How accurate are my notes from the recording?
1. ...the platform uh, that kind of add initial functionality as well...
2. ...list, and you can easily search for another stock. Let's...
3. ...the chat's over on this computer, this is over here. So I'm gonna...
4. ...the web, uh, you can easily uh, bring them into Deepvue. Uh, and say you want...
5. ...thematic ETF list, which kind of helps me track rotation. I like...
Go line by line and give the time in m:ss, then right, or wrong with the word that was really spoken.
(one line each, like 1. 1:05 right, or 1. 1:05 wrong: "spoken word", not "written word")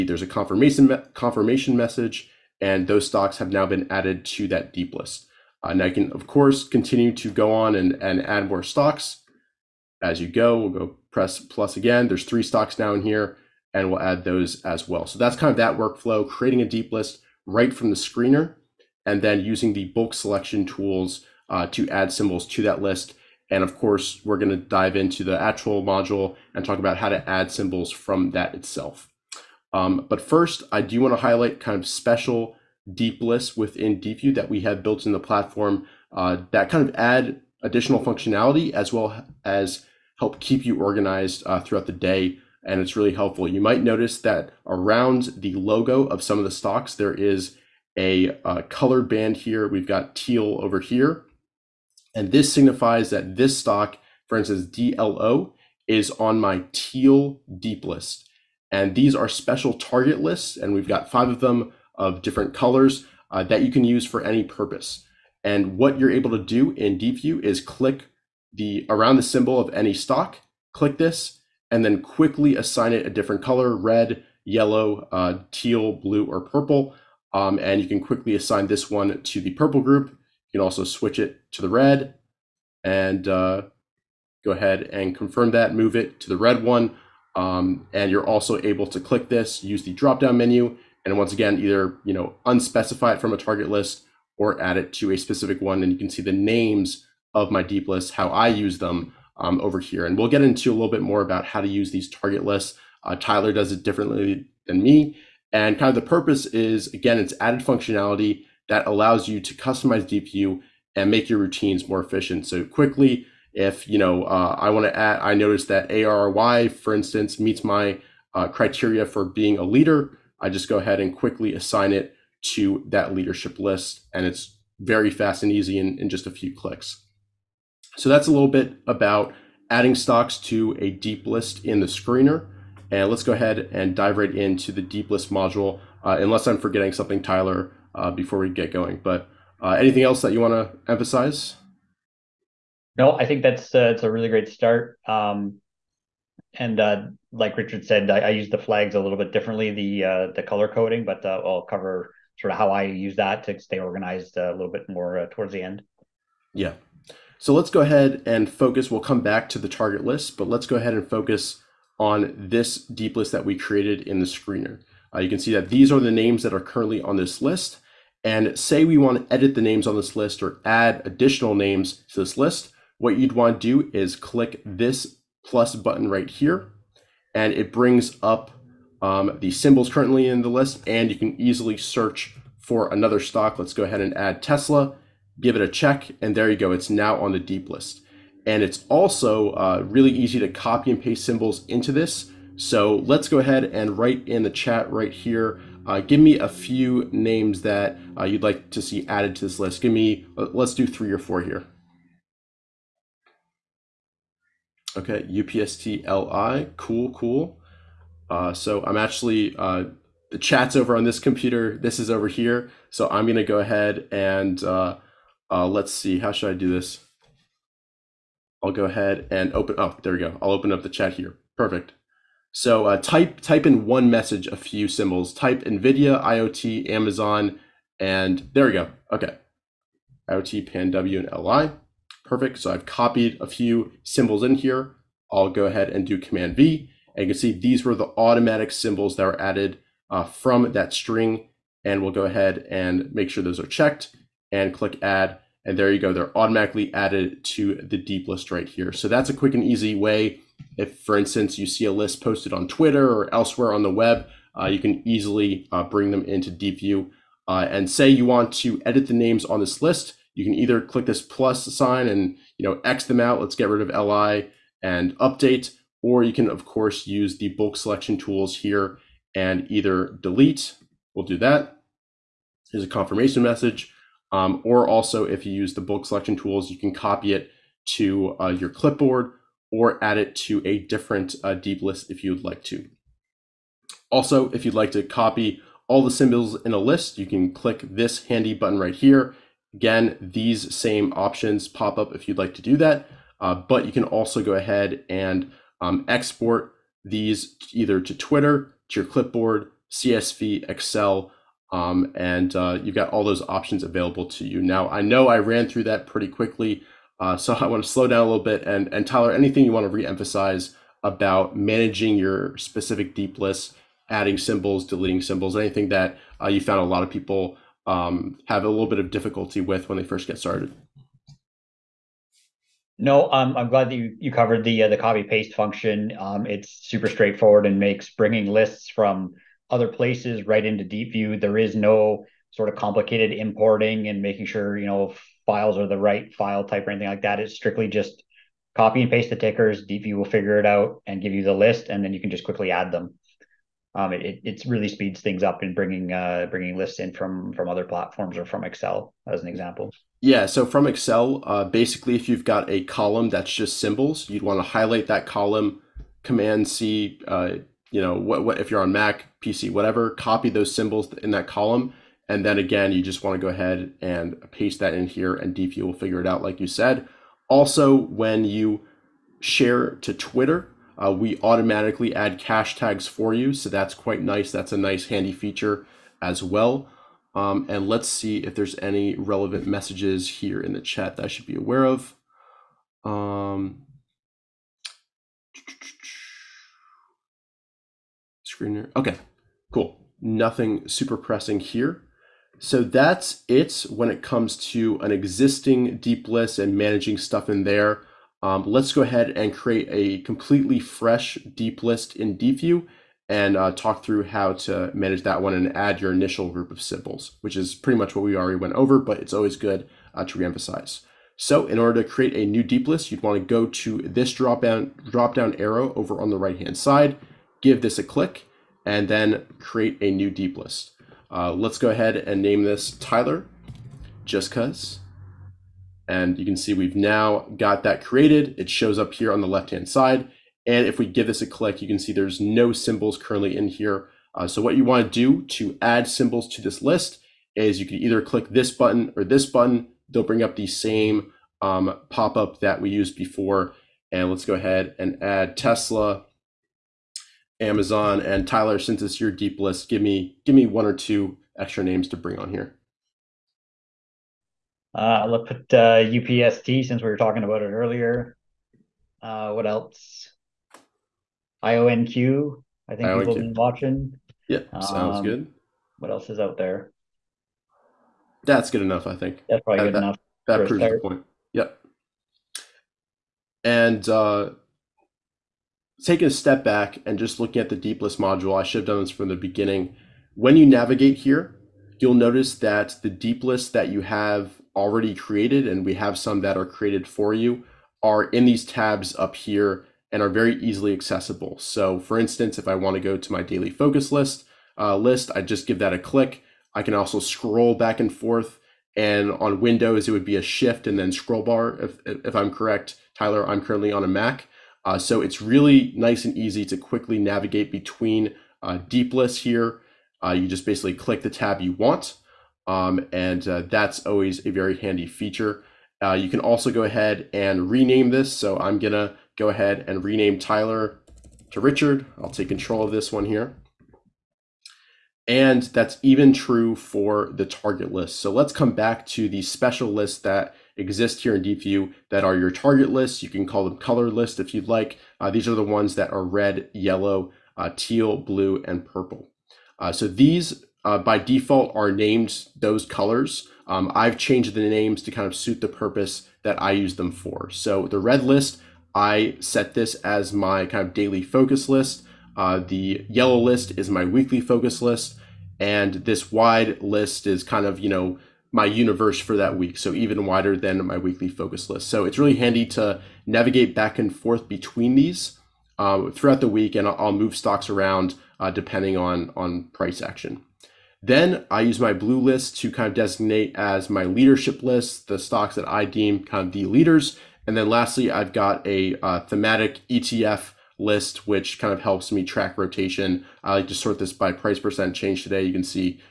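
1. 0:35 wrong: "additional", not "initial"
2. 3:00 right
3. 3:30 right
4. 4:13 right
5. 9:39 right.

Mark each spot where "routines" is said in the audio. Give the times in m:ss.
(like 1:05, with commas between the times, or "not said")
1:51.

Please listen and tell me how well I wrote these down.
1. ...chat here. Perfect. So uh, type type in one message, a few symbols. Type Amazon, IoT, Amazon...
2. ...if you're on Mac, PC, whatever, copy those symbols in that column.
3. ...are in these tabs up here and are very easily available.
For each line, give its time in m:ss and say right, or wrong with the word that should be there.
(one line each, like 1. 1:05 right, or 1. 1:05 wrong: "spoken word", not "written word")
1. 3:40 wrong: "NVIDIA", not "Amazon"
2. 5:58 right
3. 8:08 wrong: "accessible", not "available".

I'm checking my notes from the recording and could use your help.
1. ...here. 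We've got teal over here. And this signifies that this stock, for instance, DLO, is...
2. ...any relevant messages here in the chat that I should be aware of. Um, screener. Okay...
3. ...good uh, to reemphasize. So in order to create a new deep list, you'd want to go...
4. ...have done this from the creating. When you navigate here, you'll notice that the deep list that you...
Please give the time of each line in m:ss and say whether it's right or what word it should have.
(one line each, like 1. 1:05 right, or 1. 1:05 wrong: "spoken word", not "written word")
1. 0:49 right
2. 6:18 right
3. 6:49 right
4. 7:58 wrong: "beginning", not "creating".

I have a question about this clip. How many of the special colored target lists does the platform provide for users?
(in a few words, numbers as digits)
5.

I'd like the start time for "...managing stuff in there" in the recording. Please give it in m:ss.
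6:36.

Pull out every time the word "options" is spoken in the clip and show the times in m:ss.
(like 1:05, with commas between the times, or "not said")
4:51, 5:03.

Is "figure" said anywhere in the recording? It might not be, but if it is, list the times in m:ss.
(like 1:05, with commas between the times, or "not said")
5:40, 6:05.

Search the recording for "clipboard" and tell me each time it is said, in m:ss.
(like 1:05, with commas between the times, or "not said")
4:38, 4:59.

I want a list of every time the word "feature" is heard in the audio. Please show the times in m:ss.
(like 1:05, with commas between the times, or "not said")
6:15, 8:35.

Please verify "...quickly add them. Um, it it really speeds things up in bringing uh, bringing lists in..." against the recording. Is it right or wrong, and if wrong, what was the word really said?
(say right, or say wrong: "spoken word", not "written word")
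right.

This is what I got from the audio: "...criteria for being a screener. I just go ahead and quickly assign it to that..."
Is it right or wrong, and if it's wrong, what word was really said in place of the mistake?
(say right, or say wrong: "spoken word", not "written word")
wrong: "leader", not "screener".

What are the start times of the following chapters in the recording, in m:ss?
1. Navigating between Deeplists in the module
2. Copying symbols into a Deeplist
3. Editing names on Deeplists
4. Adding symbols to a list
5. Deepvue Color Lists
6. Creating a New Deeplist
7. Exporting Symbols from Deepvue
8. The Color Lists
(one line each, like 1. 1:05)
1. 7:58
2. 4:03
3. 2:58
4. 7:13
5. 0:48
6. 6:41
7. 4:58
8. 8:48.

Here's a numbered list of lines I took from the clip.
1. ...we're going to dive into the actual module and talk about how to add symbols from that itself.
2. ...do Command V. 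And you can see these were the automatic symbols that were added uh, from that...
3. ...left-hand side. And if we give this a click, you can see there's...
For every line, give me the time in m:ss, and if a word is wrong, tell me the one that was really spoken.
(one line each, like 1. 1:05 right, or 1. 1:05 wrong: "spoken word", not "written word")
1. 0:24 right
2. 3:56 right
3. 7:09 right.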